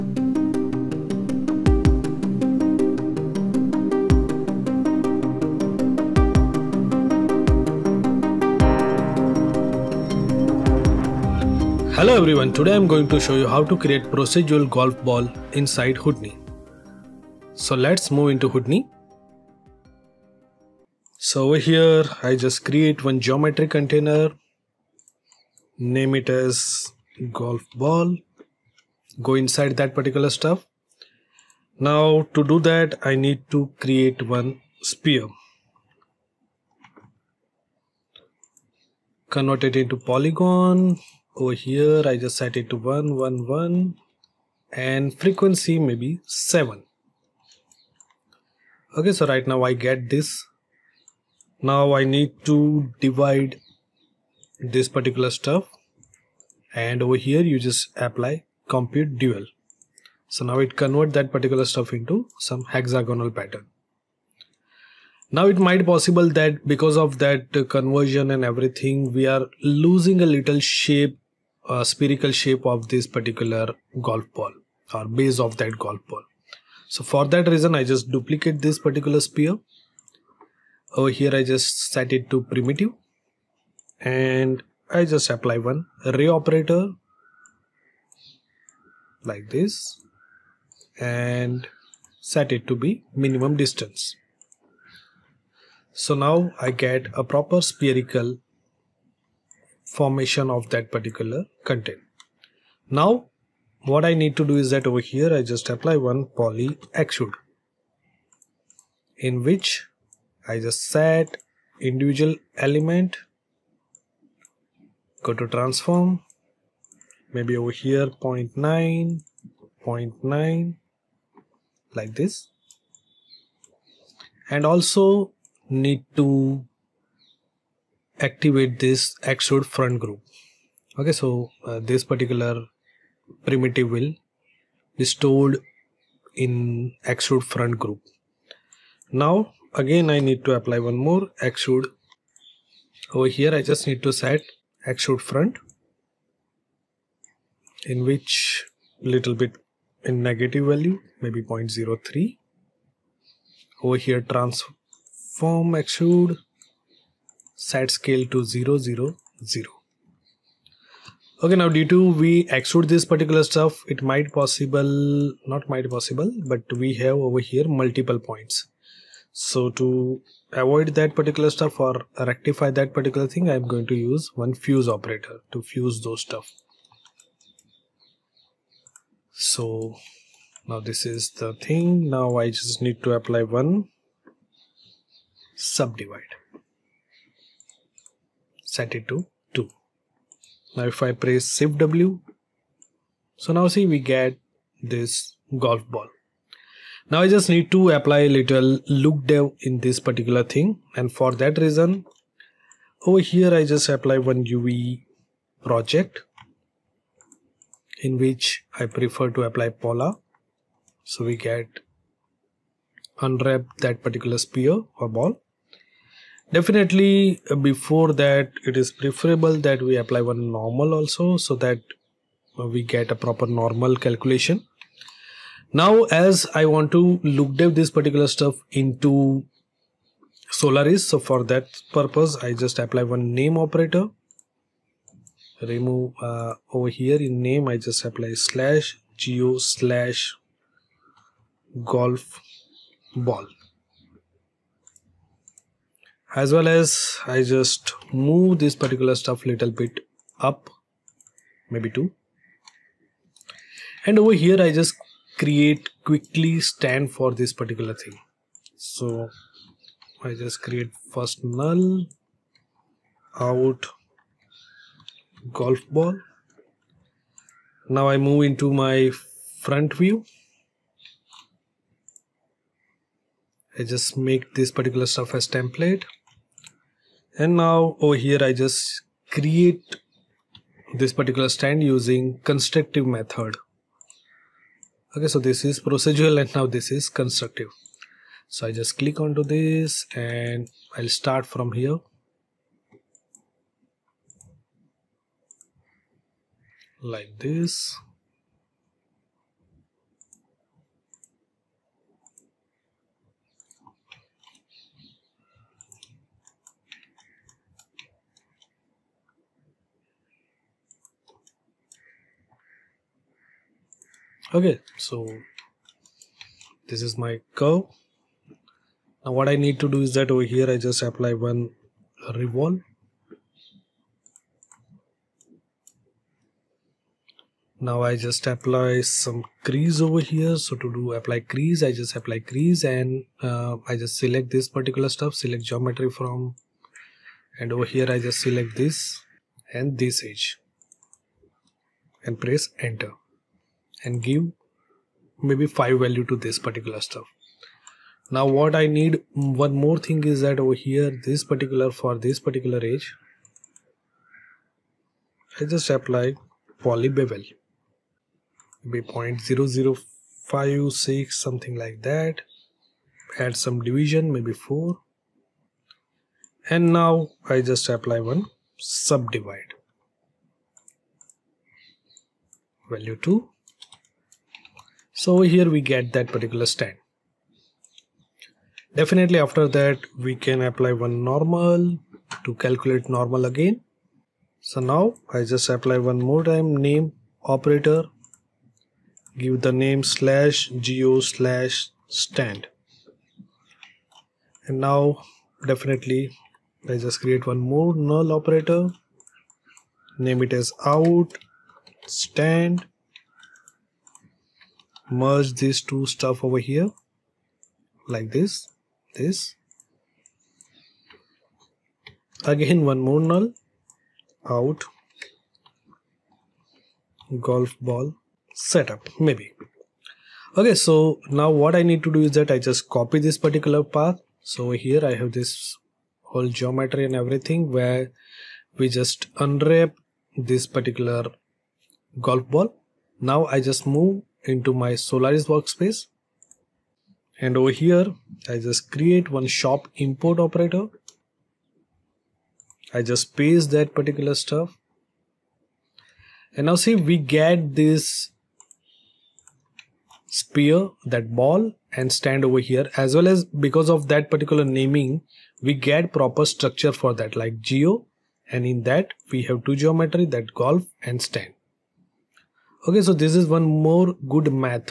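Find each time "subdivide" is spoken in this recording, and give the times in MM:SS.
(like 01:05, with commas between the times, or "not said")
03:05, 06:08.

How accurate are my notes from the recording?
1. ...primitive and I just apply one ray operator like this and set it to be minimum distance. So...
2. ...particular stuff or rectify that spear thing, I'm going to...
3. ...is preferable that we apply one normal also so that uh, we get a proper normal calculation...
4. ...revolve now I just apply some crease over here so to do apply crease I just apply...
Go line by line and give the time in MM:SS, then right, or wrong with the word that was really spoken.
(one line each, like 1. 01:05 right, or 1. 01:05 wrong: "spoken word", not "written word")
1. 01:22 right
2. 02:51 wrong: "particular", not "spear"
3. 03:38 right
4. 05:22 right.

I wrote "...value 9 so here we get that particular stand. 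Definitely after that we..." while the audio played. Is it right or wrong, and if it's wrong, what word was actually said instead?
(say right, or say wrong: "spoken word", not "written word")
wrong: "2", not "9".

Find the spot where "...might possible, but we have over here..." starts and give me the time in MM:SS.
02:45.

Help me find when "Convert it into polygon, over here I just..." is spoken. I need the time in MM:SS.
00:39.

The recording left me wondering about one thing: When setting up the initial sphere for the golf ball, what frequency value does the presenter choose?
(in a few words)
7.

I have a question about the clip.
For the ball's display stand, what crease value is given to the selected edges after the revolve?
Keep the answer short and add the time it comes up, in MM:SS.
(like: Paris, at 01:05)
5, at 05:45.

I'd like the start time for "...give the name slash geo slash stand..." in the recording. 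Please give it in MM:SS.
06:29.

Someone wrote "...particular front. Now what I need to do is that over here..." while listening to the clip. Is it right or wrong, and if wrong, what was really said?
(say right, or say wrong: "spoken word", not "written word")
wrong: "content", not "front".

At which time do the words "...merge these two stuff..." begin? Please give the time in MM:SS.
06:45.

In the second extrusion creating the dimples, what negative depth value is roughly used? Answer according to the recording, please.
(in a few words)
-0.03.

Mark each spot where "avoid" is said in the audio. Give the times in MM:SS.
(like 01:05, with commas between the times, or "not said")
02:50.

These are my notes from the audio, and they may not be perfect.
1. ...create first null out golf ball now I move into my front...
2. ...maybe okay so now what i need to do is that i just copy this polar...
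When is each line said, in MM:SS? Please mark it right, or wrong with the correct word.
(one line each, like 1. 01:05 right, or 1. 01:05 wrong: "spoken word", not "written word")
1. 04:20 right
2. 06:59 wrong: "particular", not "polar".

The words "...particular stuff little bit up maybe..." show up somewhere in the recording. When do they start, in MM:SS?
04:08.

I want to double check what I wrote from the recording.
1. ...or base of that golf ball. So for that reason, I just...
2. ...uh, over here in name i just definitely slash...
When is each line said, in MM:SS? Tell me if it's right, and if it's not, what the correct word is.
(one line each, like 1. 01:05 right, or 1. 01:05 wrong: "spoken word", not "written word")
1. 01:14 right
2. 03:56 wrong: "apply", not "definitely".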